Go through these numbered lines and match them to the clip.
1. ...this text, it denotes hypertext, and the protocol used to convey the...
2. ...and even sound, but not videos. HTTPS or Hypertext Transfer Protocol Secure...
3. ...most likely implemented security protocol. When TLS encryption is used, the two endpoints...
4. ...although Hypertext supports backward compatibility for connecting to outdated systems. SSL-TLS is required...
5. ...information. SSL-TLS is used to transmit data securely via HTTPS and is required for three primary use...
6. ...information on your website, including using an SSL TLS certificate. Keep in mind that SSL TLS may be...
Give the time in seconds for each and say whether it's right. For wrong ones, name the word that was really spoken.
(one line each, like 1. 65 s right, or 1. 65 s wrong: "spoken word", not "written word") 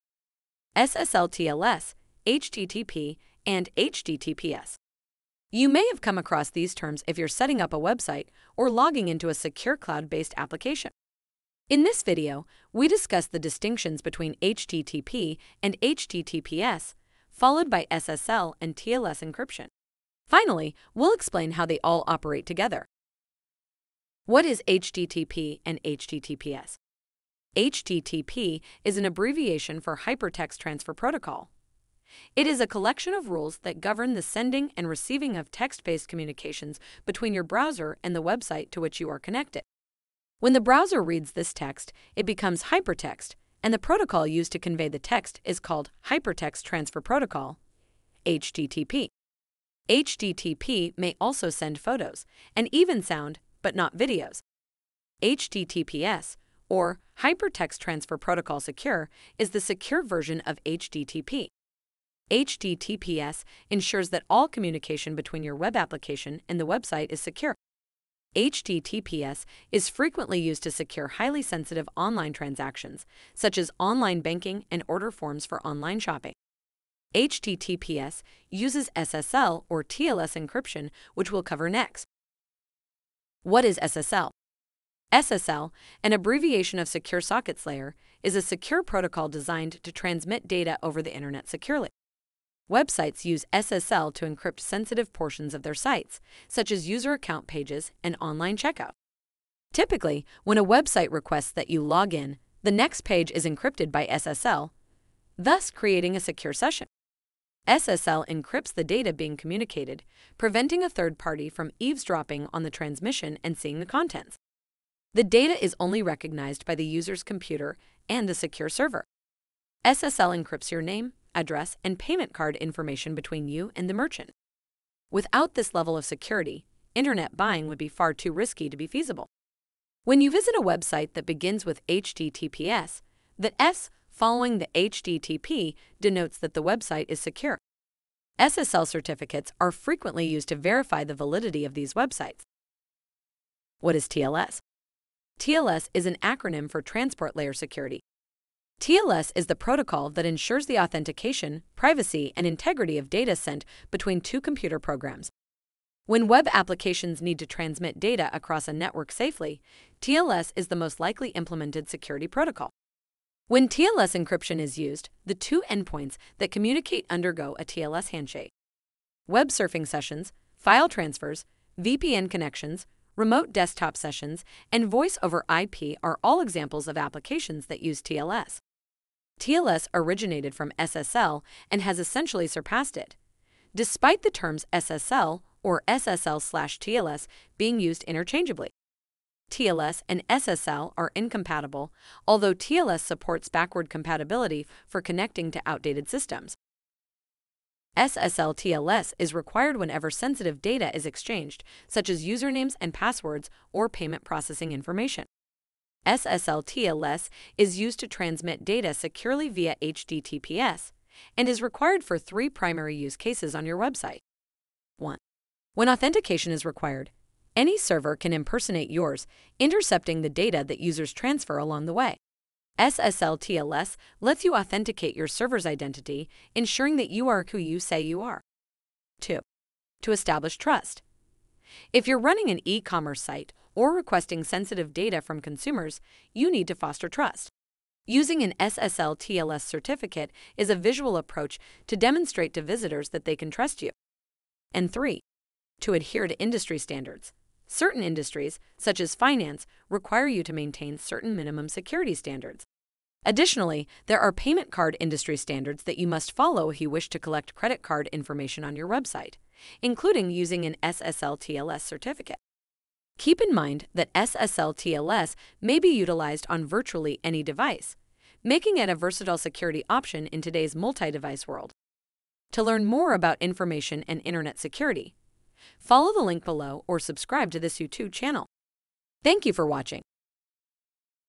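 1. 41 s wrong: "becomes", not "denotes"
2. 52 s right
3. 160 s right
4. 192 s wrong: "TLS", not "Hypertext"
5. 204 s right
6. 258 s right.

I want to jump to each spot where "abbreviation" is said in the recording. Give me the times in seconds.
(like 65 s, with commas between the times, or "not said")
29 s, 86 s.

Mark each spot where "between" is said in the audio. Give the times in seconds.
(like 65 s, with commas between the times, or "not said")
14 s, 37 s, 65 s, 123 s, 153 s.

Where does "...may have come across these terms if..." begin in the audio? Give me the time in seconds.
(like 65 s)
5 s.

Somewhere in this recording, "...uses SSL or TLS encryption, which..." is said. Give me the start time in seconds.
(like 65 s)
78 s.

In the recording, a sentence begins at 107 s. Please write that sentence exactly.
SSL encrypts the data being communicated, preventing a third party from eavesdropping on the transmission and seeing the contents.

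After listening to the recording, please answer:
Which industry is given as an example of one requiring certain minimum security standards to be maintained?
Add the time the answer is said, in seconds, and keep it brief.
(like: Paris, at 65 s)
finance, at 249 s.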